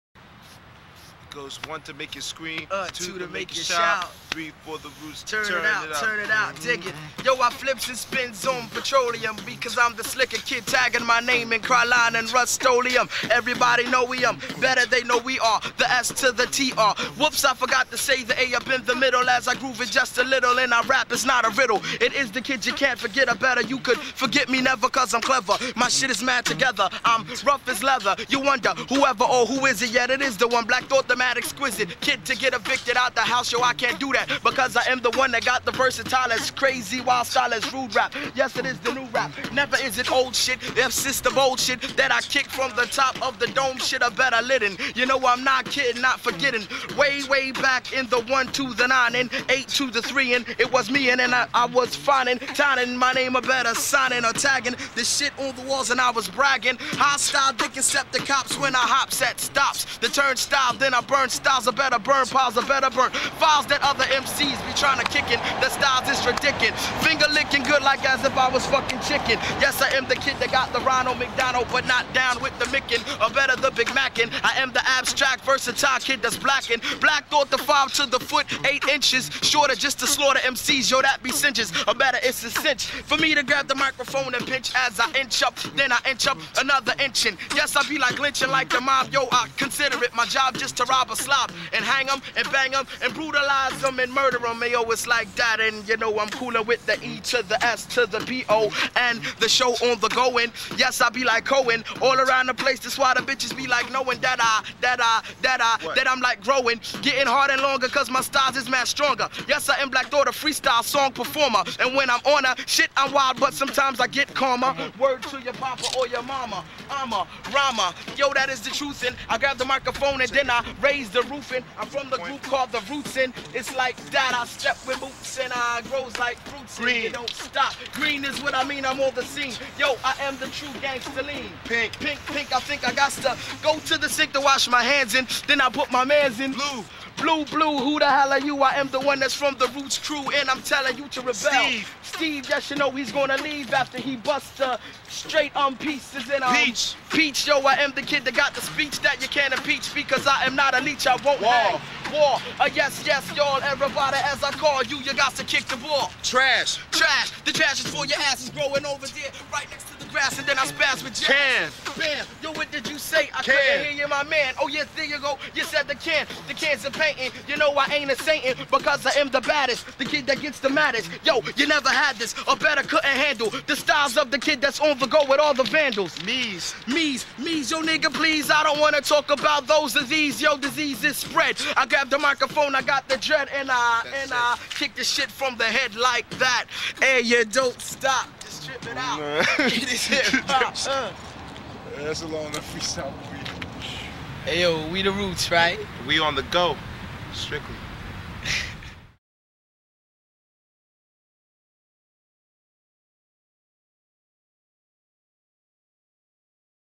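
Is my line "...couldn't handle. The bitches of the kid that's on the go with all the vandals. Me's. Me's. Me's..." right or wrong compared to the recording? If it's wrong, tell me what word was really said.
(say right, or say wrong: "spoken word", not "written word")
wrong: "styles", not "bitches".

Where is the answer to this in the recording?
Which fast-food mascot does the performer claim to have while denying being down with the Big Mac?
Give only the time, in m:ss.
1:10.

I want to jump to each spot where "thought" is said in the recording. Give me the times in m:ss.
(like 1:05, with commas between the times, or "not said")
0:30, 1:17.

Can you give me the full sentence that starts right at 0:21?
It's not a riddle, it is the kid you can't forget.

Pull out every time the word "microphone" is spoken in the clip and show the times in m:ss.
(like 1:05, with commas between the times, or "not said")
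1:23, 1:59, 3:02.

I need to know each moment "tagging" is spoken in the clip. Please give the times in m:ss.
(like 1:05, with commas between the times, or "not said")
0:10, 0:54.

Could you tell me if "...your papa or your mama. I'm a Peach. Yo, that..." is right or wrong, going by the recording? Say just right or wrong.
wrong.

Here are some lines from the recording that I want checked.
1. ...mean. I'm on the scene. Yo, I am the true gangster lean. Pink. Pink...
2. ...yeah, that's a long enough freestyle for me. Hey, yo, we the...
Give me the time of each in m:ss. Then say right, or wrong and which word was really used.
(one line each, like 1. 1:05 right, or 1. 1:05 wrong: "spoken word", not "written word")
1. 2:08 right
2. 3:12 right.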